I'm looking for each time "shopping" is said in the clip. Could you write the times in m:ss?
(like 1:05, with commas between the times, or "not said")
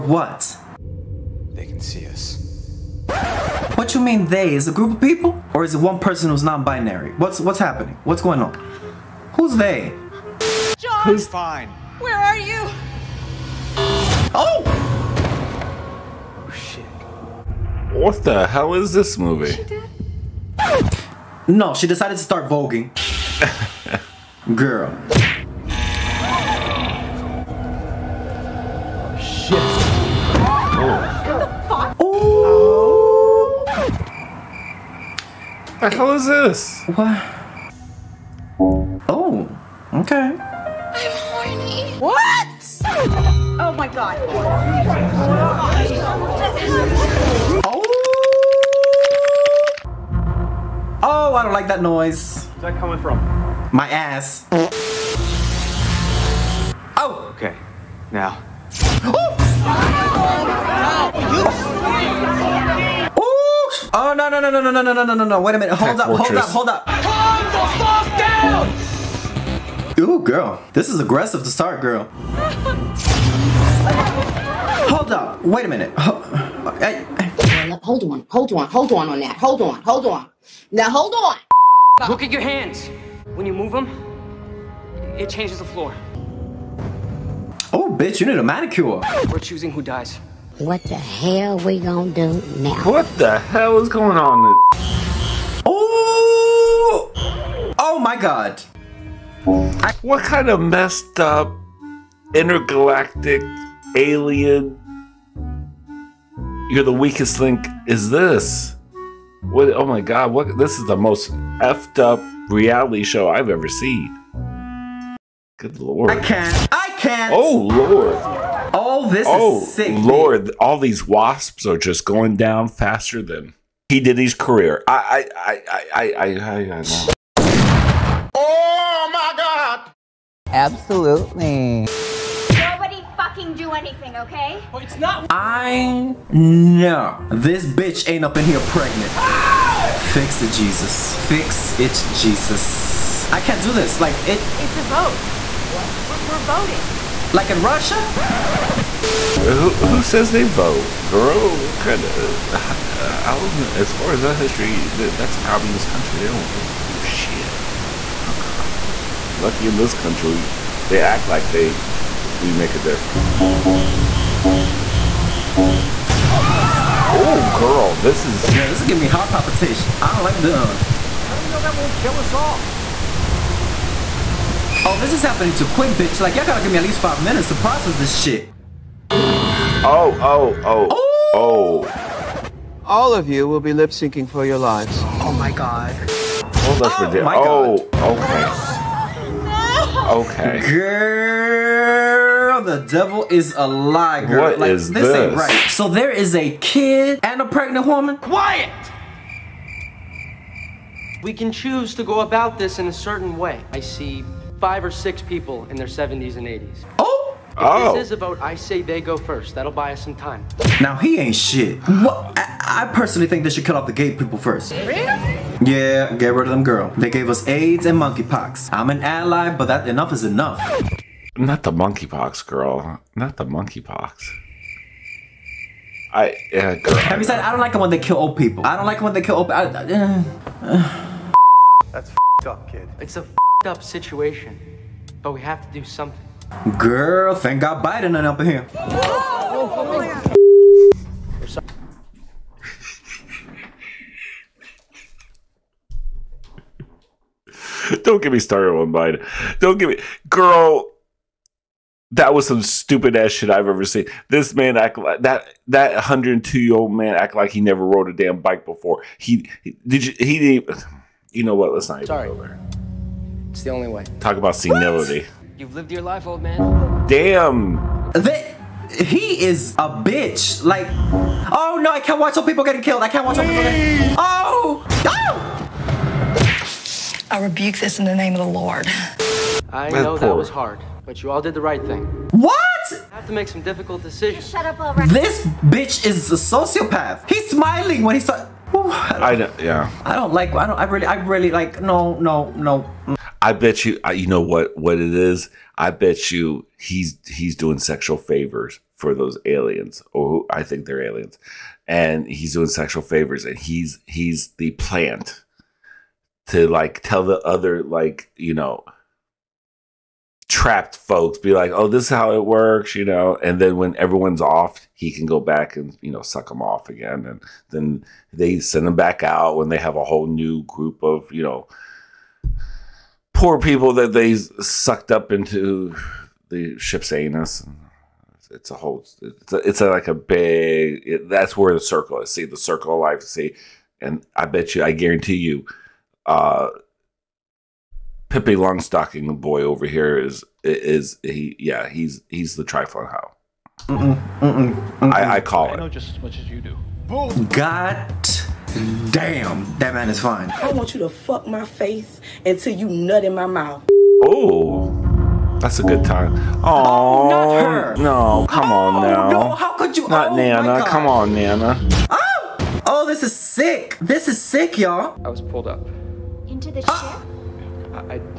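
not said.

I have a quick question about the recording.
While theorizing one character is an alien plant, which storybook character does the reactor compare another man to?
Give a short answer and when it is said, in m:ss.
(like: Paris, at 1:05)
Pippi Longstocking, at 5:38.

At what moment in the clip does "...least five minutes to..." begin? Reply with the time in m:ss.
2:56.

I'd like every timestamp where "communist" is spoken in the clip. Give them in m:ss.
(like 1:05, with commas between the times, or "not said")
2:35.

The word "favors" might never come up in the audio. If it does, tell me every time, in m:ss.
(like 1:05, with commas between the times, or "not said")
4:58, 5:03.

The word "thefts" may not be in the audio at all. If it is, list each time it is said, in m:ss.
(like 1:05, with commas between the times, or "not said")
not said.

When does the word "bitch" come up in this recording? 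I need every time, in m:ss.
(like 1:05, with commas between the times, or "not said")
1:27, 2:17, 2:55, 4:30, 4:45.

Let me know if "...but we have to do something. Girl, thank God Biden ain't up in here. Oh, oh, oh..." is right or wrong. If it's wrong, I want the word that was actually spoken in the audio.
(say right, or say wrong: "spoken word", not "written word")
right.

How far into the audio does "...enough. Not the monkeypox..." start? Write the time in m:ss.
3:40.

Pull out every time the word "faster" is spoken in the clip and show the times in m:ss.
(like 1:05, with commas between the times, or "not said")
2:02.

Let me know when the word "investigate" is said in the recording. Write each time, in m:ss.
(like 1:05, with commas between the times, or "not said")
not said.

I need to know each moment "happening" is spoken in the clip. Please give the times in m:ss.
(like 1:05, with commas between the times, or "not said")
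0:07, 2:55.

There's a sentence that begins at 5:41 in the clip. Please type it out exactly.
Yeah, he's he's the trifling How.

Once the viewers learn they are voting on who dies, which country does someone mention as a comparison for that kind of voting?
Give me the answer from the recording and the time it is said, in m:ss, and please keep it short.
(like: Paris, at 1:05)
Russia, at 2:27.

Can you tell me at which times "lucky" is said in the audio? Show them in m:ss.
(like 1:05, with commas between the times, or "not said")
2:39.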